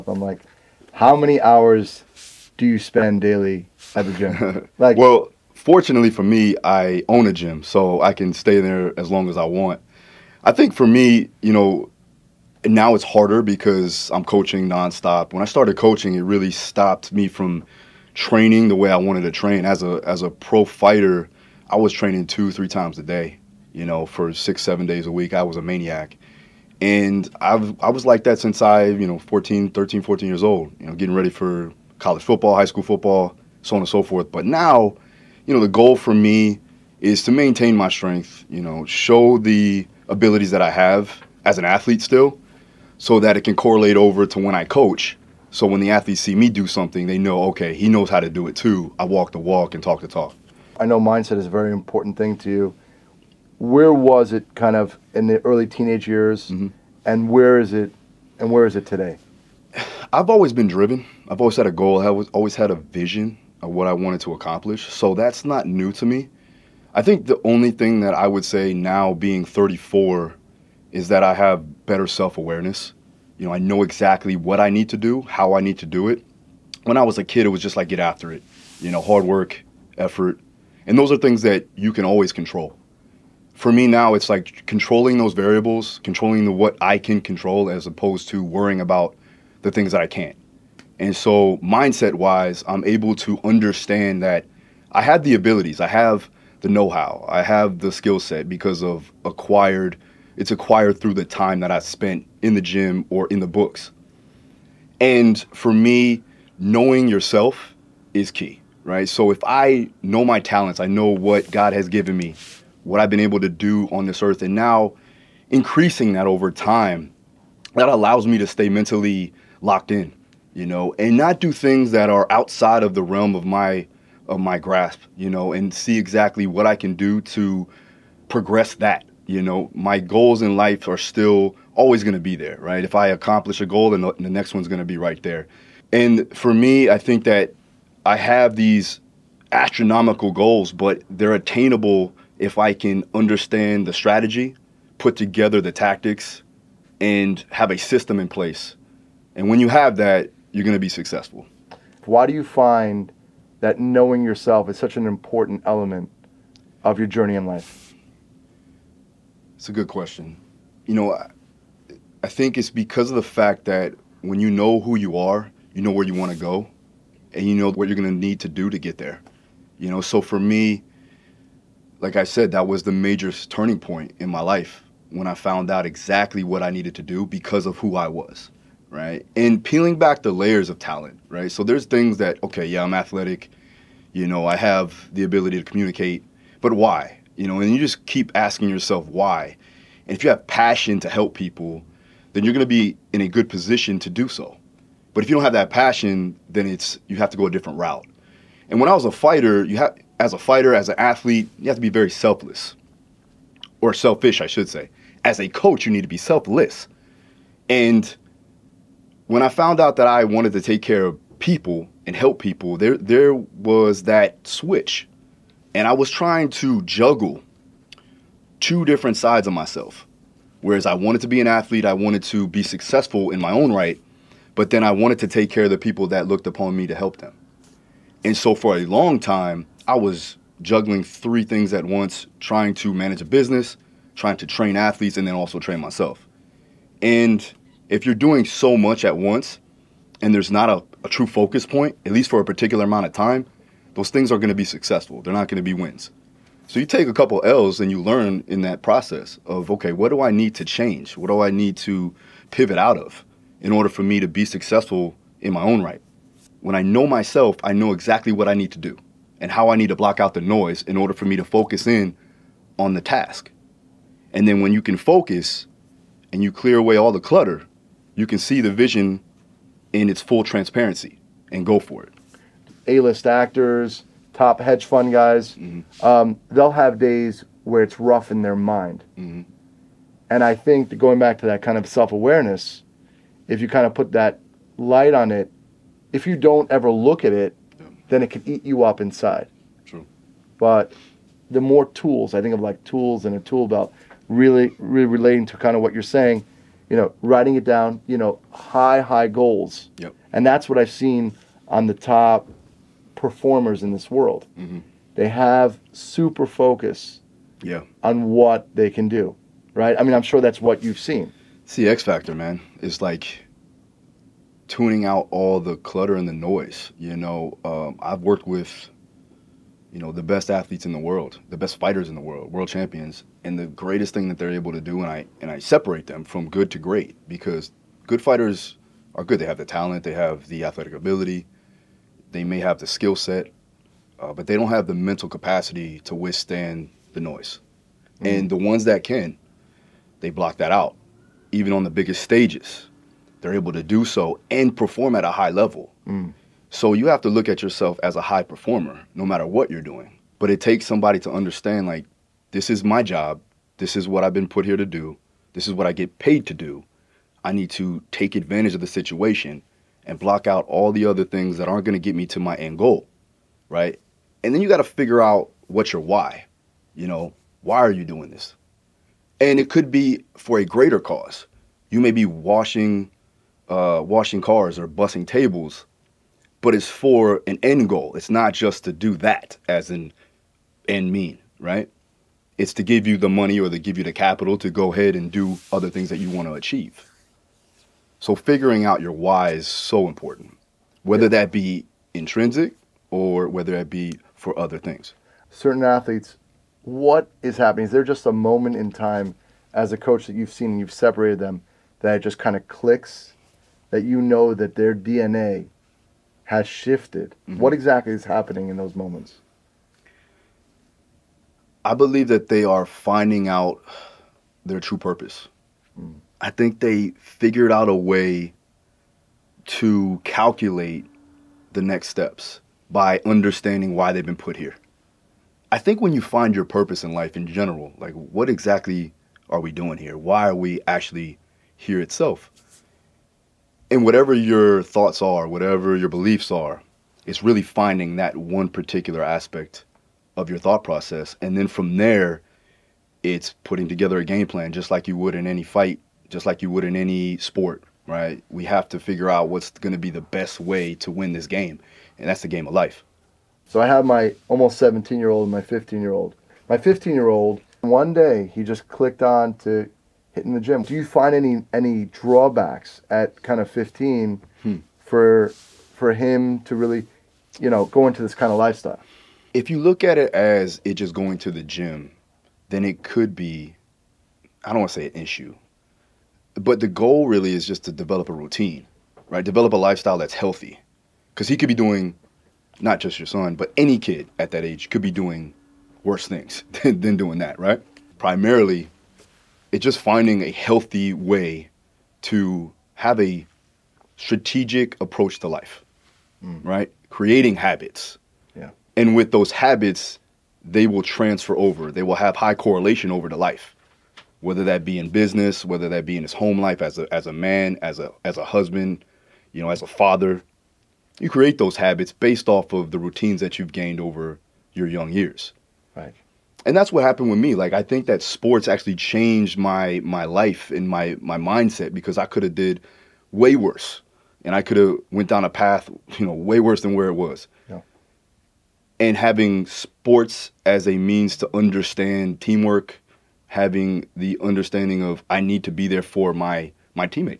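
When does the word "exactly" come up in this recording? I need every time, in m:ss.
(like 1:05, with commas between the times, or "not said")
1:13, 2:05, 2:55, 4:17, 6:47, 7:08.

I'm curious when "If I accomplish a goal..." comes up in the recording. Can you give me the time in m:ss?
2:12.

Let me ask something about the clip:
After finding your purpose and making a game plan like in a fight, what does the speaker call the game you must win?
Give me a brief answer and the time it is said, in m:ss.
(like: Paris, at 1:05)
The game of life, at 7:32.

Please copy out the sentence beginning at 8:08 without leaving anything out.
Primarily it's just finding a healthy way to have a strategic approach to life, mm.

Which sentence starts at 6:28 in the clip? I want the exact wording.
So figuring out your why is so important, whether that be intrinsic or whether that be for other things.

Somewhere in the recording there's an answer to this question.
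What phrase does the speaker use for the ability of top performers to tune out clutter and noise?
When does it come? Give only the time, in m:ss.
5:11.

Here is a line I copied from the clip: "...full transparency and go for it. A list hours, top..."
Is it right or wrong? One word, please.
wrong.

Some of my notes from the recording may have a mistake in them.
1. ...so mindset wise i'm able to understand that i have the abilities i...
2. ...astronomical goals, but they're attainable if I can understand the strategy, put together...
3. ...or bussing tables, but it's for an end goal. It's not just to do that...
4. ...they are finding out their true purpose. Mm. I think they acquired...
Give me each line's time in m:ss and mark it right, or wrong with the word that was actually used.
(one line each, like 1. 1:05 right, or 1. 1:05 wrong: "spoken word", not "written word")
1. 1:31 right
2. 2:19 right
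3. 6:14 right
4. 6:52 wrong: "figured", not "acquired".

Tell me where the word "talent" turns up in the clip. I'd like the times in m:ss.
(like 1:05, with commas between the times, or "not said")
1:50, 3:00, 5:29.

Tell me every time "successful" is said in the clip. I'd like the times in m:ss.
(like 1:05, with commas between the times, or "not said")
2:30, 3:42, 4:04, 4:14.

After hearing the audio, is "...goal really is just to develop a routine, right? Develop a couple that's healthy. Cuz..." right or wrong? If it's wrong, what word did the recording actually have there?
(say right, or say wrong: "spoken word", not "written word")
wrong: "lifestyle", not "couple".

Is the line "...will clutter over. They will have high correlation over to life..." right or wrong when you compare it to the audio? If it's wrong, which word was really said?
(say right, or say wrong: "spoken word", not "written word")
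wrong: "transfer", not "clutter".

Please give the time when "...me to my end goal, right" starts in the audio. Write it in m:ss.
6:02.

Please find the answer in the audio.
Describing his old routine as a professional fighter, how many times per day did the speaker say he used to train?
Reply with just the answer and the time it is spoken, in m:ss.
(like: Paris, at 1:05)
2 or 3 times a day, at 0:22.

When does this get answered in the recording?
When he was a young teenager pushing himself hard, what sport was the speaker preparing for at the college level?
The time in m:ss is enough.
0:31.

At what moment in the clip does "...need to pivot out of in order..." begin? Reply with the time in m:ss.
4:11.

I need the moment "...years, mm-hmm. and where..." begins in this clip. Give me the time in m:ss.
0:56.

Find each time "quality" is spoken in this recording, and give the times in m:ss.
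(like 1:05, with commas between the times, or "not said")
not said.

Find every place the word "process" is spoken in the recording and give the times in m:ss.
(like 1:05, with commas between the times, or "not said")
4:08, 7:20.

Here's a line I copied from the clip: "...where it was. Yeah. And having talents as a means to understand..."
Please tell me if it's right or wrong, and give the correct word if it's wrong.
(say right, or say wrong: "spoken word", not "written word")
wrong: "sports", not "talents".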